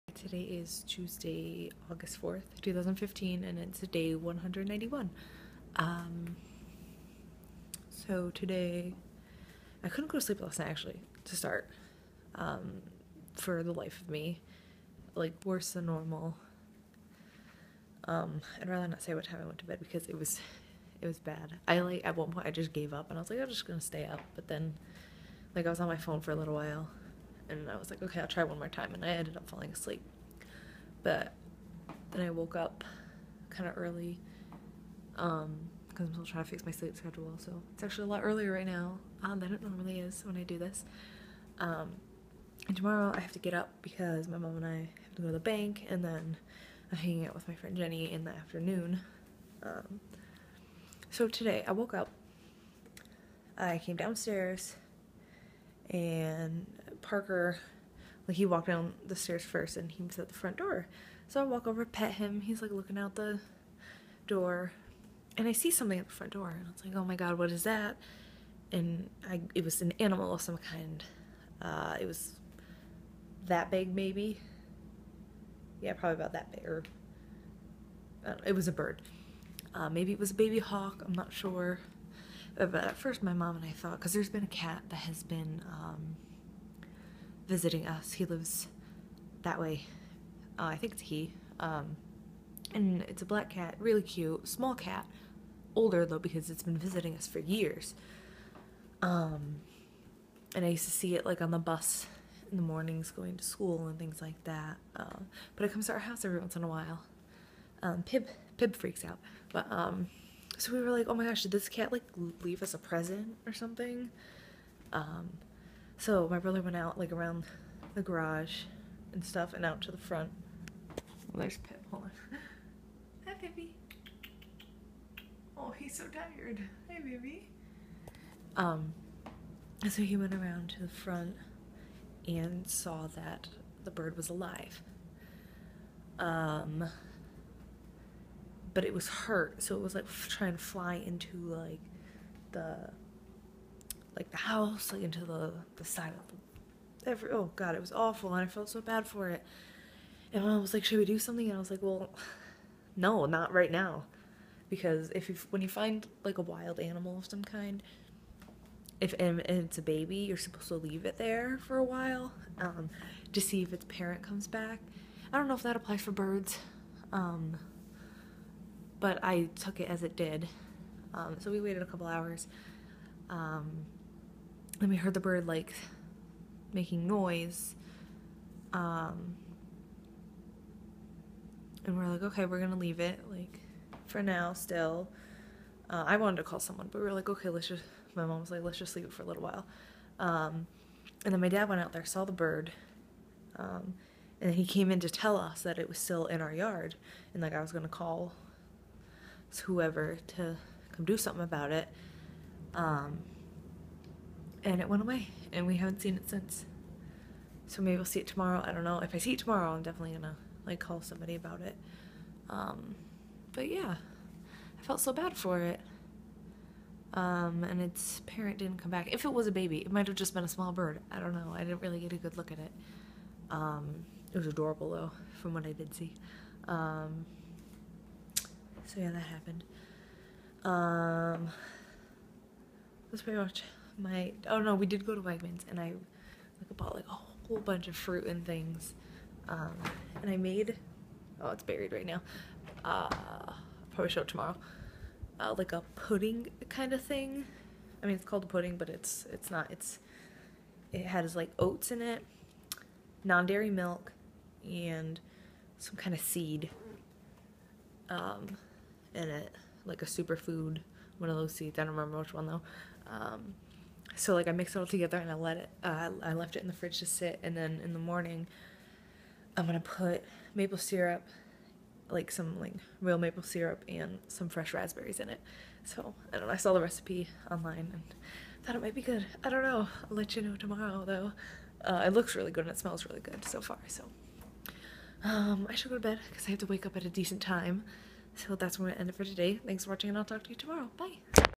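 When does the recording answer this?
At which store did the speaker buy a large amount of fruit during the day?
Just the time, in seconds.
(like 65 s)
235 s.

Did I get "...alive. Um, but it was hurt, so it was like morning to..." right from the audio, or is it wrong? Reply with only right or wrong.
wrong.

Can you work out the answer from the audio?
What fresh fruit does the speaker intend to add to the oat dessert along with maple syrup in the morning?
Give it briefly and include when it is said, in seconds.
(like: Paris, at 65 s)
Raspberries, at 274 s.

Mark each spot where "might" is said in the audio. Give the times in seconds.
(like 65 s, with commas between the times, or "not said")
219 s, 278 s.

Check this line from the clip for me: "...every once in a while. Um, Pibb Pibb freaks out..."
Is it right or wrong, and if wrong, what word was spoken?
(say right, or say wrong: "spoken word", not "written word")
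right.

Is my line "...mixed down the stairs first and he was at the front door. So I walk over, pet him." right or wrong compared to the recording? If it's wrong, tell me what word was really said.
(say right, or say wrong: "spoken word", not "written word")
wrong: "walked", not "mixed".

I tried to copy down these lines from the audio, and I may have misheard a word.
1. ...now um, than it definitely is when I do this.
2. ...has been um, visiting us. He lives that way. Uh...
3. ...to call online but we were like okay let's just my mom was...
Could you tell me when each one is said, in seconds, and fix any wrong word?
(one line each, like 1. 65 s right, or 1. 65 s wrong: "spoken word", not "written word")
1. 38 s wrong: "normally", not "definitely"
2. 84 s right
3. 186 s wrong: "someone", not "online".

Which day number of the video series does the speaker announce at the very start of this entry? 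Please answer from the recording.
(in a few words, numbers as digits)
191.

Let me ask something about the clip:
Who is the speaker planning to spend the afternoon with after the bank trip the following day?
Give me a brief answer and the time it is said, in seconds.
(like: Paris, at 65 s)
Jenny, at 47 s.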